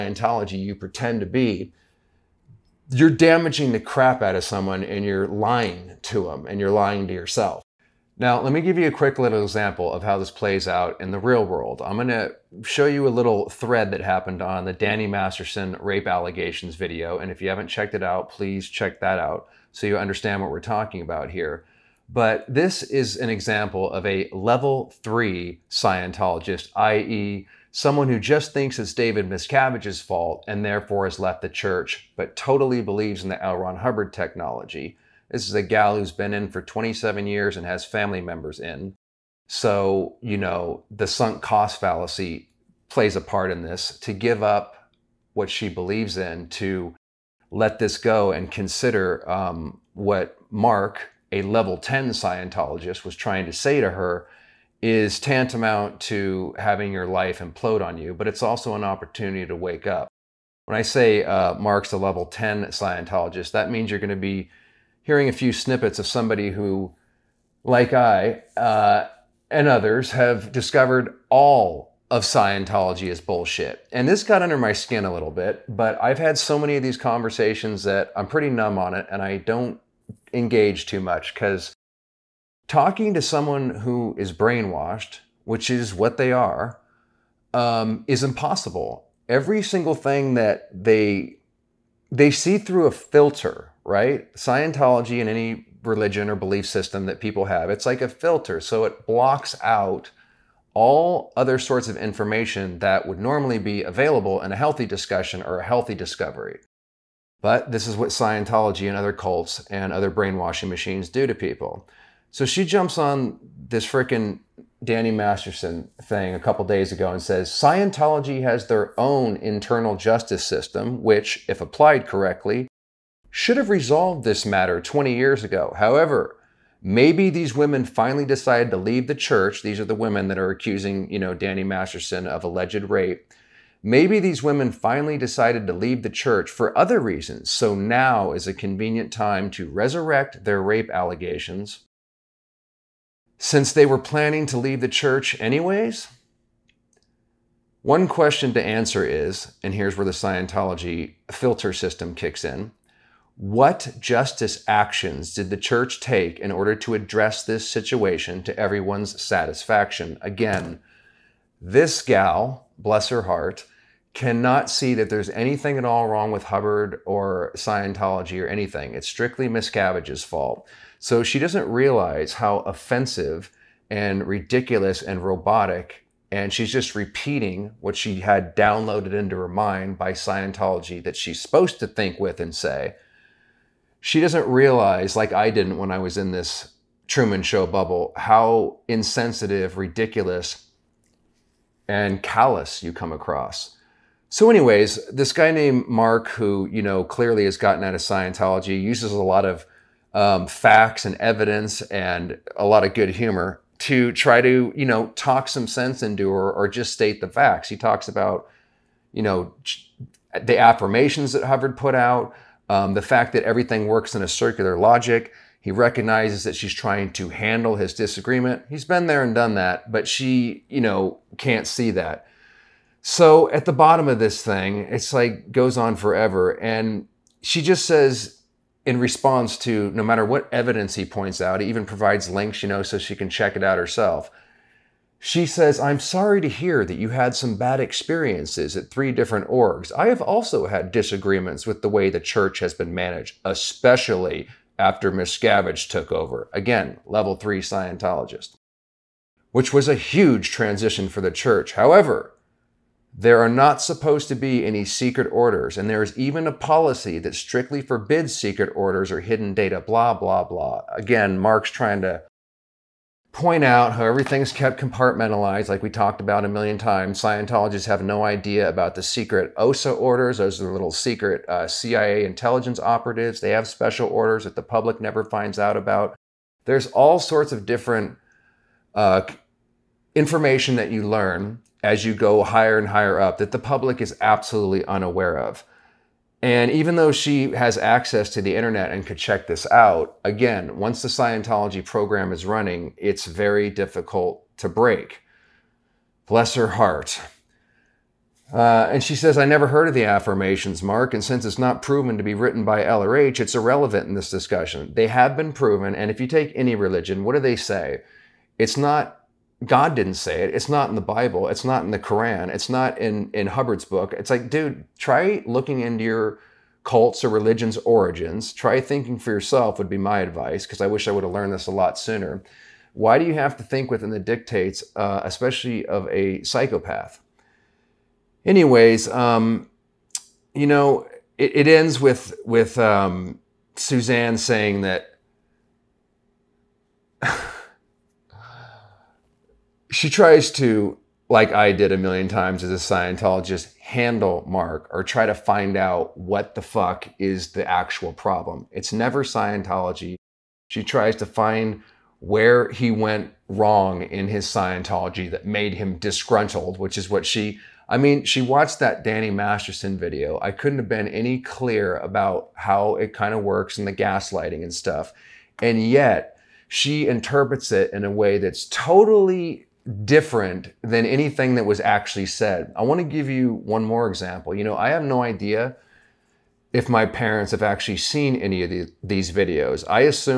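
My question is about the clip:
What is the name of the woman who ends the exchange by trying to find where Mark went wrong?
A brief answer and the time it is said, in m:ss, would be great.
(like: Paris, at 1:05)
Suzanne, at 5:33.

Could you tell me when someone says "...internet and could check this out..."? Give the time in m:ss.
4:48.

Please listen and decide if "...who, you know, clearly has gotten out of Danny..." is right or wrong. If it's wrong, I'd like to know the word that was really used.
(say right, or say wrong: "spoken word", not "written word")
wrong: "Scientology", not "Danny".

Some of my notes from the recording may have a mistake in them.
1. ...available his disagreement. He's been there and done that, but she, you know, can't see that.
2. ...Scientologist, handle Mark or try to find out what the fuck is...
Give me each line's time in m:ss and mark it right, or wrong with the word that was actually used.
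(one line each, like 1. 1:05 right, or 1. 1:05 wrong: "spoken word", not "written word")
1. 3:37 wrong: "handle", not "available"
2. 5:42 right.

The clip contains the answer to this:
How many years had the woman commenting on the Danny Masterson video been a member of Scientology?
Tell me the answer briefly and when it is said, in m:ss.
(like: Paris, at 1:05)
27, at 0:36.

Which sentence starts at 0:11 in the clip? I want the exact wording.
I'm going to show you a little thread that happened on the Danny Masterson rape allegations video.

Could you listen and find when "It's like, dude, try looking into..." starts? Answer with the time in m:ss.
5:14.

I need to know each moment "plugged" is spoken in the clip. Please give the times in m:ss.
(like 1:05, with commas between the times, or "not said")
not said.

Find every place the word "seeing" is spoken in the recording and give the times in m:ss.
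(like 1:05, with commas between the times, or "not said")
not said.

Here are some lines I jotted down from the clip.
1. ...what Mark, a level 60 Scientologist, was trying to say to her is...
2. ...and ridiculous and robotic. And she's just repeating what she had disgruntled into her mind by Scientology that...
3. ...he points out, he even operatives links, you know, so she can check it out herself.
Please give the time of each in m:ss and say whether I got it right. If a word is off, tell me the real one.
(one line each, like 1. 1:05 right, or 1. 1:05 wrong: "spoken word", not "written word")
1. 0:49 wrong: "10", not "60"
2. 2:53 wrong: "downloaded", not "disgruntled"
3. 3:50 wrong: "provides", not "operatives".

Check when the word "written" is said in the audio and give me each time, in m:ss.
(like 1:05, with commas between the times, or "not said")
5:02.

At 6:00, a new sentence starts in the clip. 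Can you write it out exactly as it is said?
I couldn't have been any clear about how it kind of works and the gaslighting and stuff.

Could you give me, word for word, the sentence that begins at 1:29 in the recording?
Every single thing that they they see through a filter, right?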